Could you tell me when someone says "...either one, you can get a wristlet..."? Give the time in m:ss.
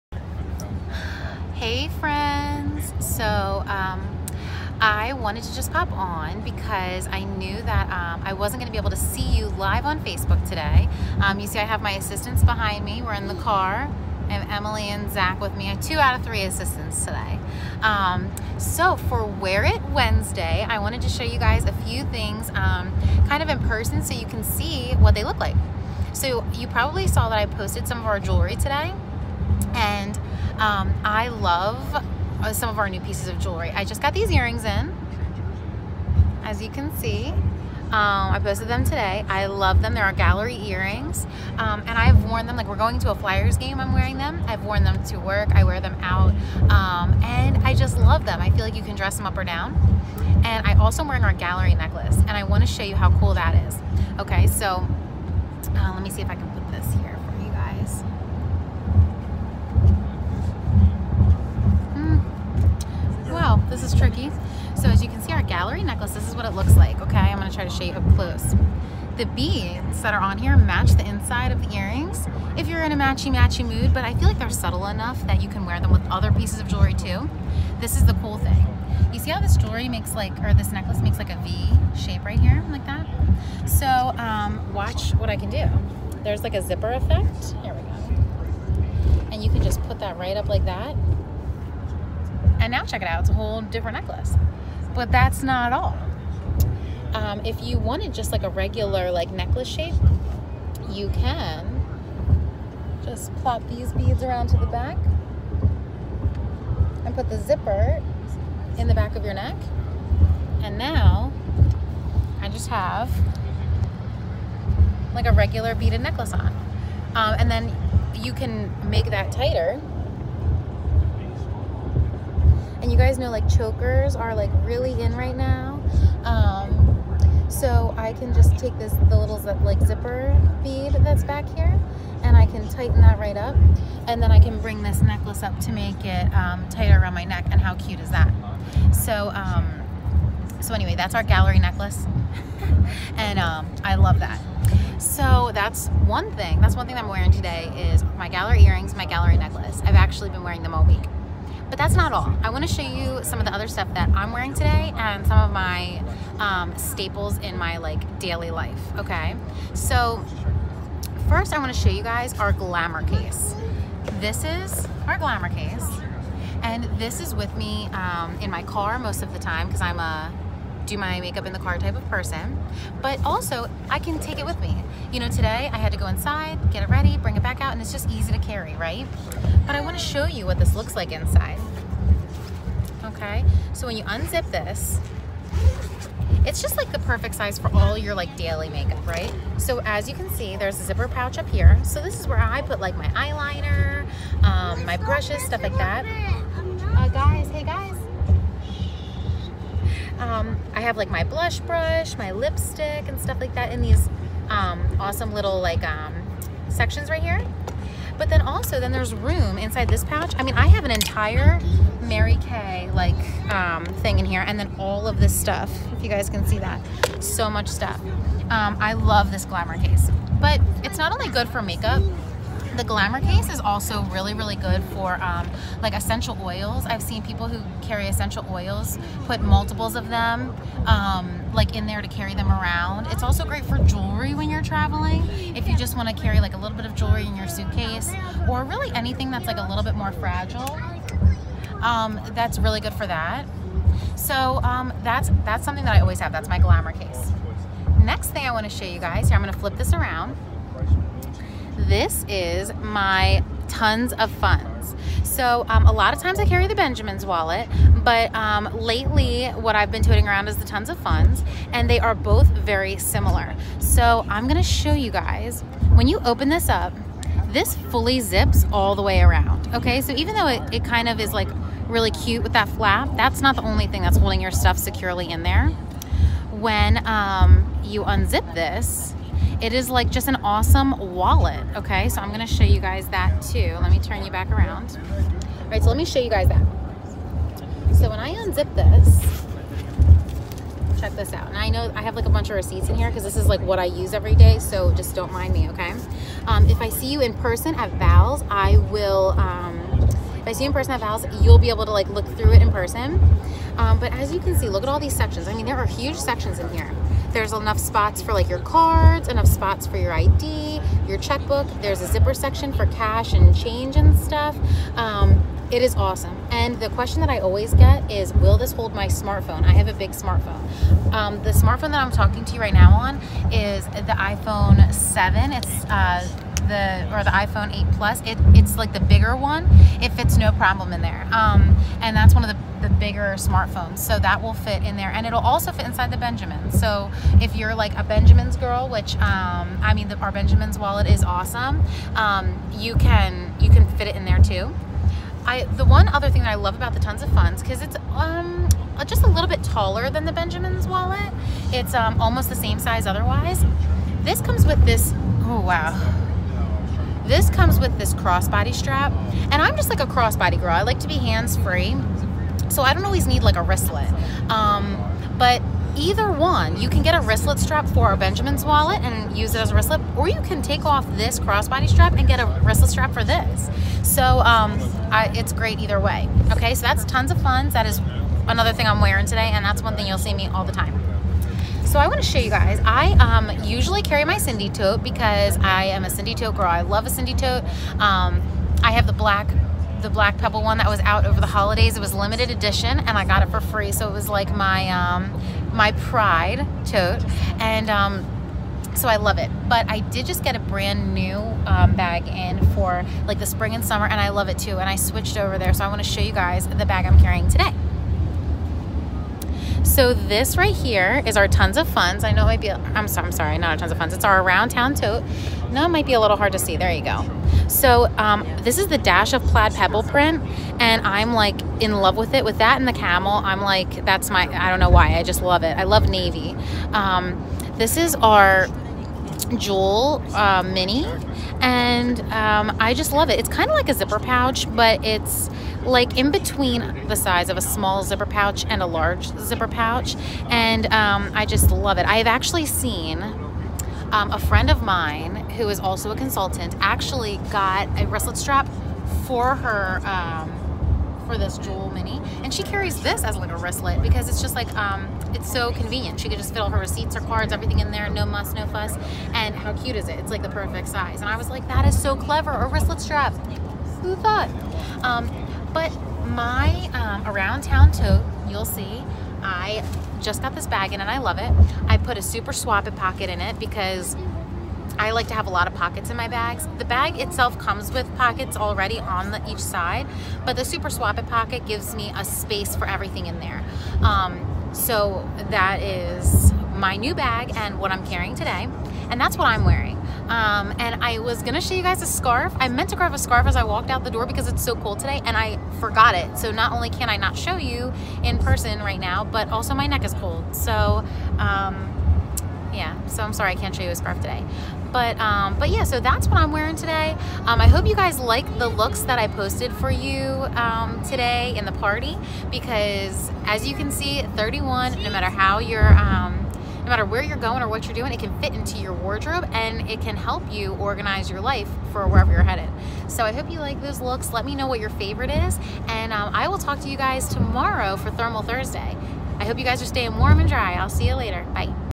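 6:05.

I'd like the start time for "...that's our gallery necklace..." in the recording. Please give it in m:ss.
2:20.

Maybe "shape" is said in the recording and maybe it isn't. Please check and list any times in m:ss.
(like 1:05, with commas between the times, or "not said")
1:21, 1:39.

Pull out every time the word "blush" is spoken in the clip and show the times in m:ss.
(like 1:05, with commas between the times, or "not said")
3:21.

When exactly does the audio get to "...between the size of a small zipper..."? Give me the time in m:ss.
7:16.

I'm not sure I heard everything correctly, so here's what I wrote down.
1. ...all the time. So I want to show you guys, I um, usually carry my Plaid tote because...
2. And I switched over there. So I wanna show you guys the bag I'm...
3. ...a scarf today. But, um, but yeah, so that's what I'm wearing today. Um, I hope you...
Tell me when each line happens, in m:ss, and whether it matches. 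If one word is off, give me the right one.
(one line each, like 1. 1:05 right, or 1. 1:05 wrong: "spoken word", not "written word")
1. 6:20 wrong: "Cindy", not "Plaid"
2. 6:44 right
3. 8:23 right.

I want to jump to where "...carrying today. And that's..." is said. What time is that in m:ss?
8:08.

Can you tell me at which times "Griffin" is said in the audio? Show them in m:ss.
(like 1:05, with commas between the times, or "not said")
not said.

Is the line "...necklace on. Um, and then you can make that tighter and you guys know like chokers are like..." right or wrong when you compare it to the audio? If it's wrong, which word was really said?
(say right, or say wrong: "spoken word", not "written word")
right.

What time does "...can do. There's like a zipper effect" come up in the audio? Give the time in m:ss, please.
1:25.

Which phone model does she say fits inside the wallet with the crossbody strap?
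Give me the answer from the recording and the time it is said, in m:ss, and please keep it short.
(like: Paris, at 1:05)
iPhone 8 Plus, at 5:27.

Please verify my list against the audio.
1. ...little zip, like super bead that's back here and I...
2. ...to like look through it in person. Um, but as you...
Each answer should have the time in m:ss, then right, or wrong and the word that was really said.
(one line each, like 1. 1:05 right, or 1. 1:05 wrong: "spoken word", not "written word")
1. 2:09 wrong: "zipper", not "super"
2. 5:01 right.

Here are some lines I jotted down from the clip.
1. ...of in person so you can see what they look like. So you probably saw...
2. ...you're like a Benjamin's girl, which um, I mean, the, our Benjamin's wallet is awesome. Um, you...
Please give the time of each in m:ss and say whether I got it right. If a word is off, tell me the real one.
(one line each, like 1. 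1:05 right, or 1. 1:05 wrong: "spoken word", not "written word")
1. 0:23 right
2. 5:37 right.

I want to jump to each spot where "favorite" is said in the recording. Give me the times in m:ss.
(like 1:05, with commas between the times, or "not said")
8:44.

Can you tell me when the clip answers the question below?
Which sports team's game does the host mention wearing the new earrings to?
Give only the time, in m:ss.
0:43.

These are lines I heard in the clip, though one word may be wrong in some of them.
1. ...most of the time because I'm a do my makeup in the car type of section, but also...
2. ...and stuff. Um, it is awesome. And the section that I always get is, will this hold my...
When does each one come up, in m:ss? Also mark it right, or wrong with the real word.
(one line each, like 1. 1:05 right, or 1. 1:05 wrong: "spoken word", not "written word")
1. 2:48 wrong: "person", not "section"
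2. 5:13 wrong: "question", not "section".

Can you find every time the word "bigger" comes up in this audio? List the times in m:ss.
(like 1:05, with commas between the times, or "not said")
5:28, 5:33.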